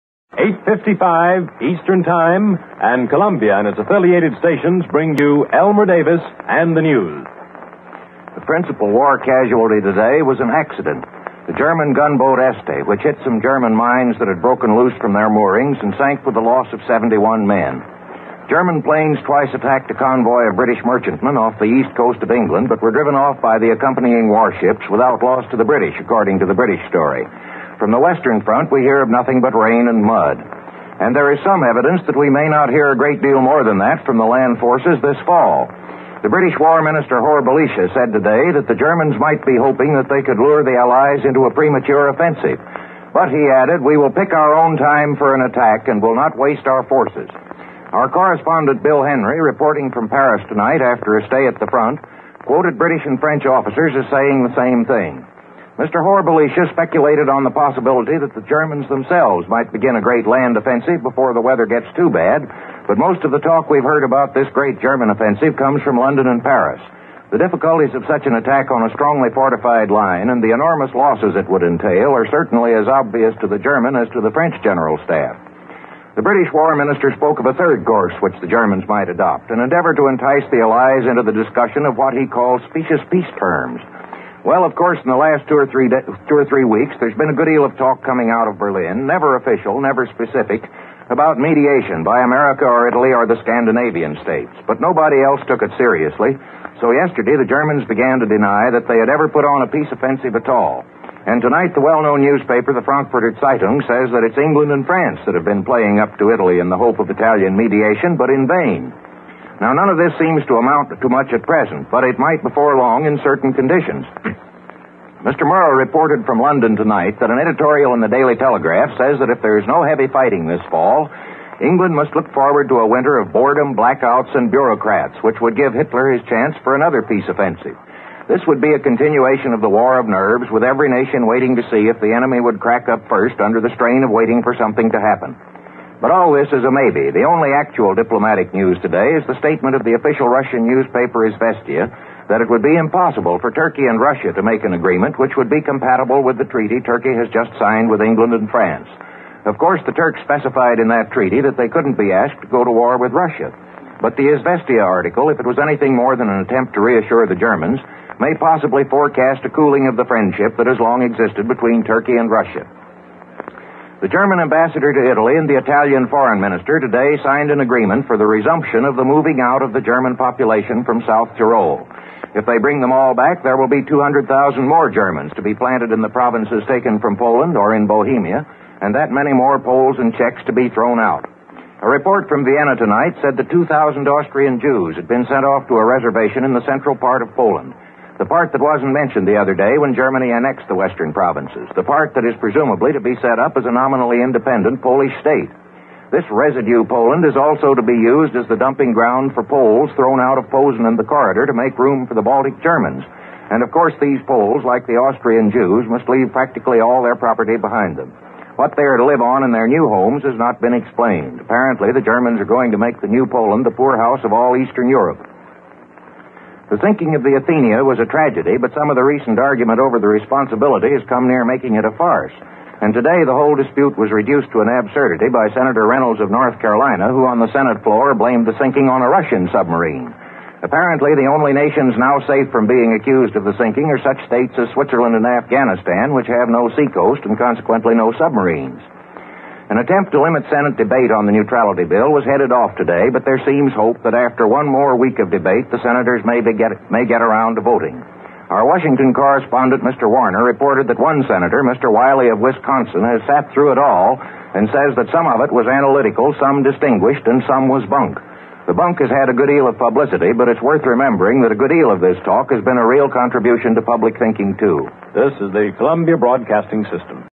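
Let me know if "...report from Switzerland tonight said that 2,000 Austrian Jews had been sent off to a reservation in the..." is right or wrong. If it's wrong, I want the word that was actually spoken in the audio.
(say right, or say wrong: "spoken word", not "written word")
wrong: "Vienna", not "Switzerland".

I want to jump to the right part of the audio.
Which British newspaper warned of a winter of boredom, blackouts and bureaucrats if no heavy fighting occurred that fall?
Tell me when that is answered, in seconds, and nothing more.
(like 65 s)
118 s.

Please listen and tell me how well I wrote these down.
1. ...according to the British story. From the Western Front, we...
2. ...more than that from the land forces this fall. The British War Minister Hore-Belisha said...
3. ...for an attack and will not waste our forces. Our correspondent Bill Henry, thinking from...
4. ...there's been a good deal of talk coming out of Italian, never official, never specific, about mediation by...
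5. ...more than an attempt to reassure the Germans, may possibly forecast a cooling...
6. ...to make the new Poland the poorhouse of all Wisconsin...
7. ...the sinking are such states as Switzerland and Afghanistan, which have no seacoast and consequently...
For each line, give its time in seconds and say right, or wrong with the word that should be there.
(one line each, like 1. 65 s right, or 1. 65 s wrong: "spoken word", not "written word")
1. 26 s right
2. 33 s right
3. 45 s wrong: "reporting", not "thinking"
4. 86 s wrong: "Berlin", not "Italian"
5. 155 s right
6. 212 s wrong: "Eastern", not "Wisconsin"
7. 233 s right.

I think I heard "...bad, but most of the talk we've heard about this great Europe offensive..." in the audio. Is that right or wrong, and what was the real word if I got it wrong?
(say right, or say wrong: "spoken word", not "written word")
wrong: "German", not "Europe".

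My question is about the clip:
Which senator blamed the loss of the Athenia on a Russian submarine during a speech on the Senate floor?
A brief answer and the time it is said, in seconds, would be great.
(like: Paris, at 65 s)
Senator Reynolds, at 225 s.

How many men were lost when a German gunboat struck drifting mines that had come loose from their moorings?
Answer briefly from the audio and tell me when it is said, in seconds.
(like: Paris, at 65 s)
71, at 16 s.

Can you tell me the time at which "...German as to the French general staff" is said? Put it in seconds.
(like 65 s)
73 s.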